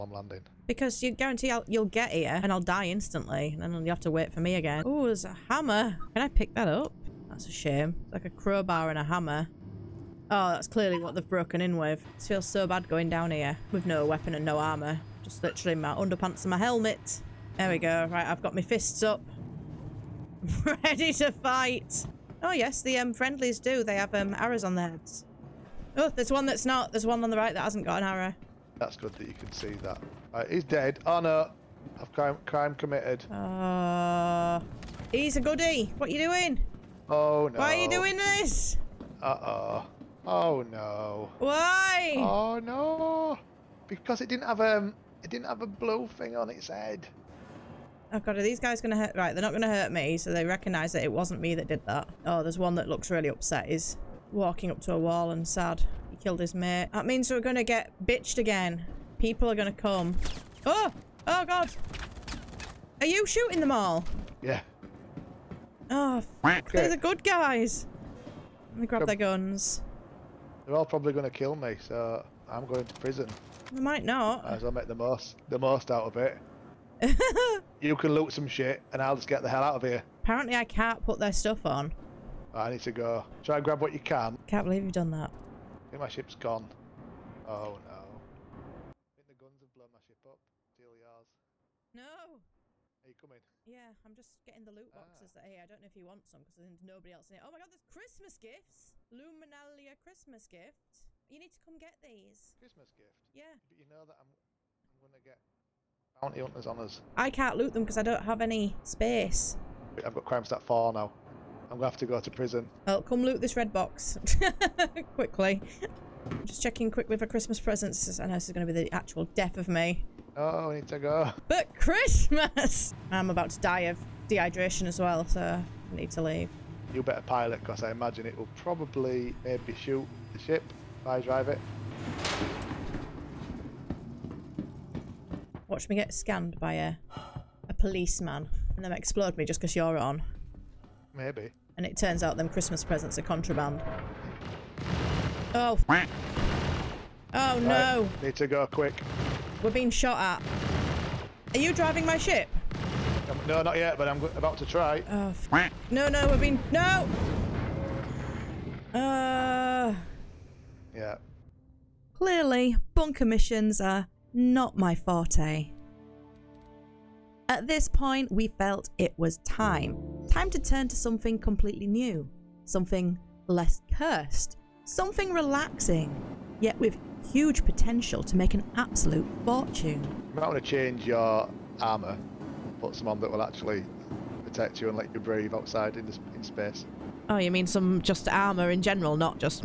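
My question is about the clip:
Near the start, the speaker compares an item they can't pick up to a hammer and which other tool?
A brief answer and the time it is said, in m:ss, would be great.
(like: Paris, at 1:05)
crowbar, at 0:08.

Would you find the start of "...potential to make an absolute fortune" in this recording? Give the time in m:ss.
2:57.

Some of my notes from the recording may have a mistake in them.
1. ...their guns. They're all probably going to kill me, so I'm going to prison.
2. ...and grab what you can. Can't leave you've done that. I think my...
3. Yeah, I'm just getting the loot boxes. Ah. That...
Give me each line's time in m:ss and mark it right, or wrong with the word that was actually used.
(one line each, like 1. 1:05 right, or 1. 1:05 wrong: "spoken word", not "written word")
1. 1:09 right
2. 1:23 wrong: "believe", not "leave"
3. 1:33 right.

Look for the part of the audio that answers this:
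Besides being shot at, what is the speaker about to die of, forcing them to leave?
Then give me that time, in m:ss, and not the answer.
2:04.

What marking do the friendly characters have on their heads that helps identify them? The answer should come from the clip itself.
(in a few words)
arrows.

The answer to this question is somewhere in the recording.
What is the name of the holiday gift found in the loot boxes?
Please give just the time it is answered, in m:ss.
1:39.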